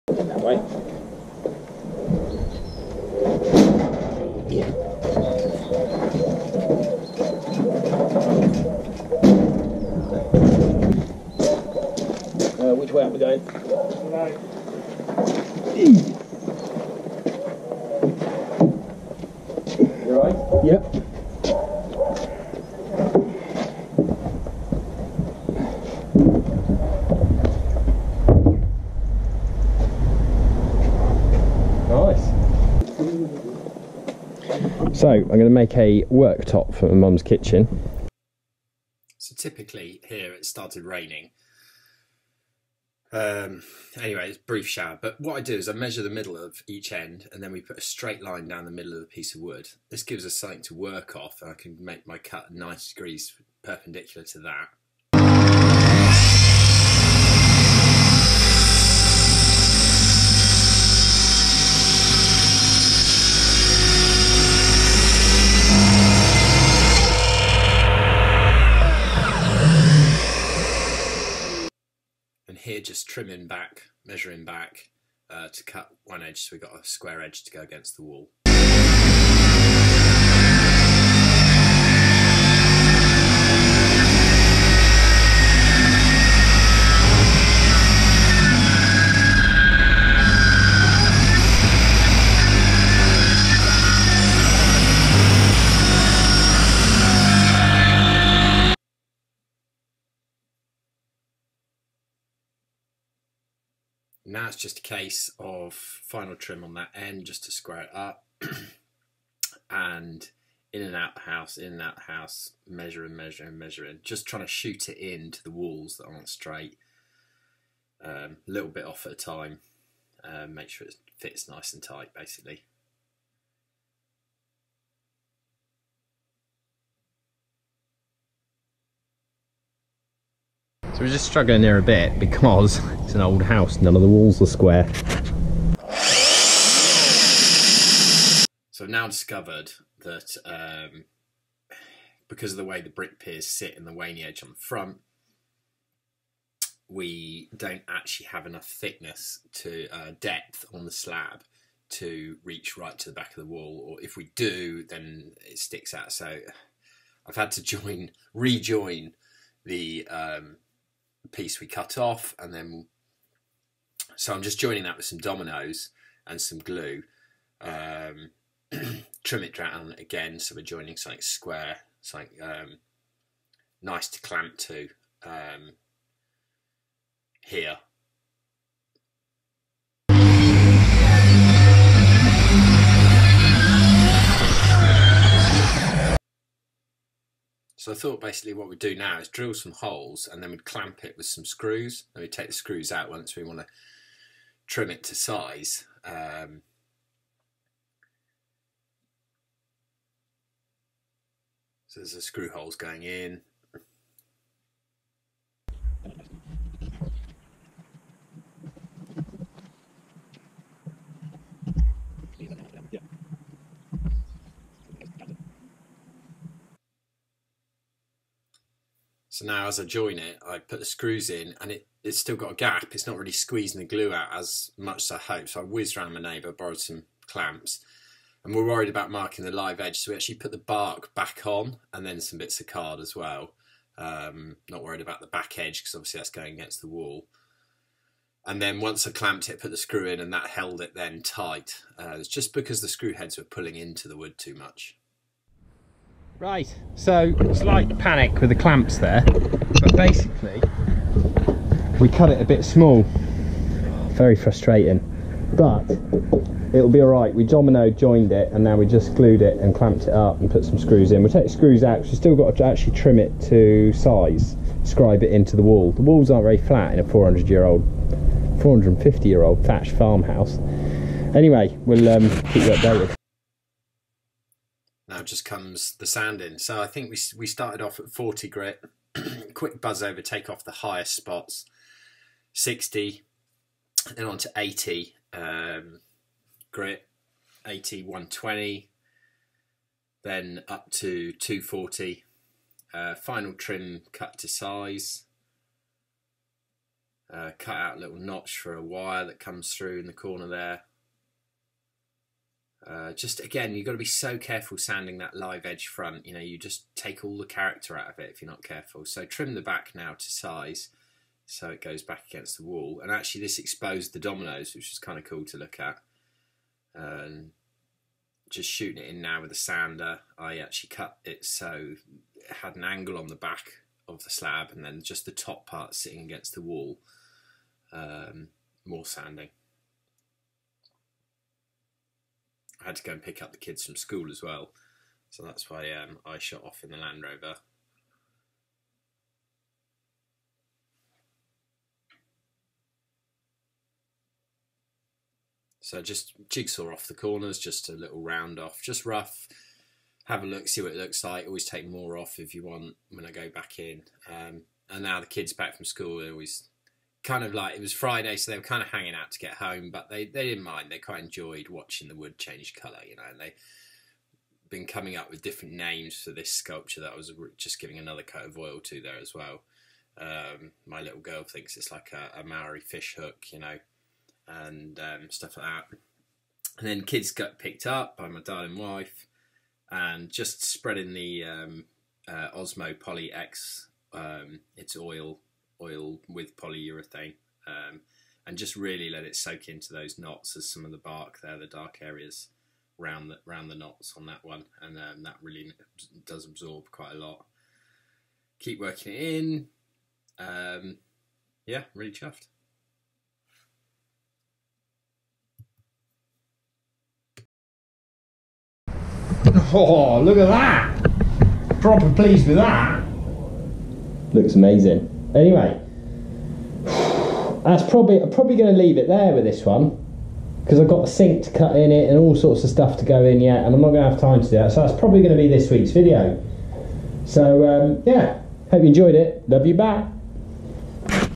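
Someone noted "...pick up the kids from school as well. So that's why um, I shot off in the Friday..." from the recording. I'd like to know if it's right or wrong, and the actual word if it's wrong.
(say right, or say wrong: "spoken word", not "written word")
wrong: "Land", not "Friday".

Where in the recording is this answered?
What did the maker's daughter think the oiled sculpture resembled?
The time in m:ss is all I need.
6:12.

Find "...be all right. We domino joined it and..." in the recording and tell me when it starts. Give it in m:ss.
4:16.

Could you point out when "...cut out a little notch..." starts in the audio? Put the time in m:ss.
4:57.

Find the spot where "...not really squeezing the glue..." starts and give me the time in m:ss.
3:43.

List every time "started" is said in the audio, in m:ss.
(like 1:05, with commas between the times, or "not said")
0:40, 4:37.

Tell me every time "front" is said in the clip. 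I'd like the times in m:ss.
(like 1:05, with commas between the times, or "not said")
2:24, 5:05.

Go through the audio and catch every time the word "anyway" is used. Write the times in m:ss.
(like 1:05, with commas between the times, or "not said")
0:43, 4:31, 6:55.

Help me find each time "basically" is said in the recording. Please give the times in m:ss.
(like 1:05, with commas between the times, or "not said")
2:02, 3:08, 4:09.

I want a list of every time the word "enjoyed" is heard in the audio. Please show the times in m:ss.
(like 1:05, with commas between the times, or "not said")
6:01, 7:08.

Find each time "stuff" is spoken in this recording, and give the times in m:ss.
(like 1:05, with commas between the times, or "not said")
6:15, 7:02.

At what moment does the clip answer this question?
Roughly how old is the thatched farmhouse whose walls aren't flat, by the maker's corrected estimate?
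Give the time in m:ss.
4:28.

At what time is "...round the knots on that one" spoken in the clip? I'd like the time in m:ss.
6:33.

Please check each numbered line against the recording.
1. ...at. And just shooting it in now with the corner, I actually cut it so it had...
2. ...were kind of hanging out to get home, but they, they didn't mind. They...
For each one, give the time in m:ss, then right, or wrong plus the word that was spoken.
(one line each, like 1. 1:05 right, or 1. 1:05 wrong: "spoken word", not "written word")
1. 5:15 wrong: "sander", not "corner"
2. 5:58 right.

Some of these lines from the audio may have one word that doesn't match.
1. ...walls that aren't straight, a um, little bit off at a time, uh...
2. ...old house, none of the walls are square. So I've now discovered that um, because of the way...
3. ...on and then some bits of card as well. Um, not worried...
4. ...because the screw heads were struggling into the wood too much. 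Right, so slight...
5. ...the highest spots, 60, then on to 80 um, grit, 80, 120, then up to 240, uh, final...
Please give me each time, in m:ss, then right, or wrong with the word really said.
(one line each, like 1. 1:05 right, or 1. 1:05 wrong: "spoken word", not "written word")
1. 1:55 right
2. 2:13 right
3. 3:51 right
4. 4:02 wrong: "pulling", not "struggling"
5. 4:40 right.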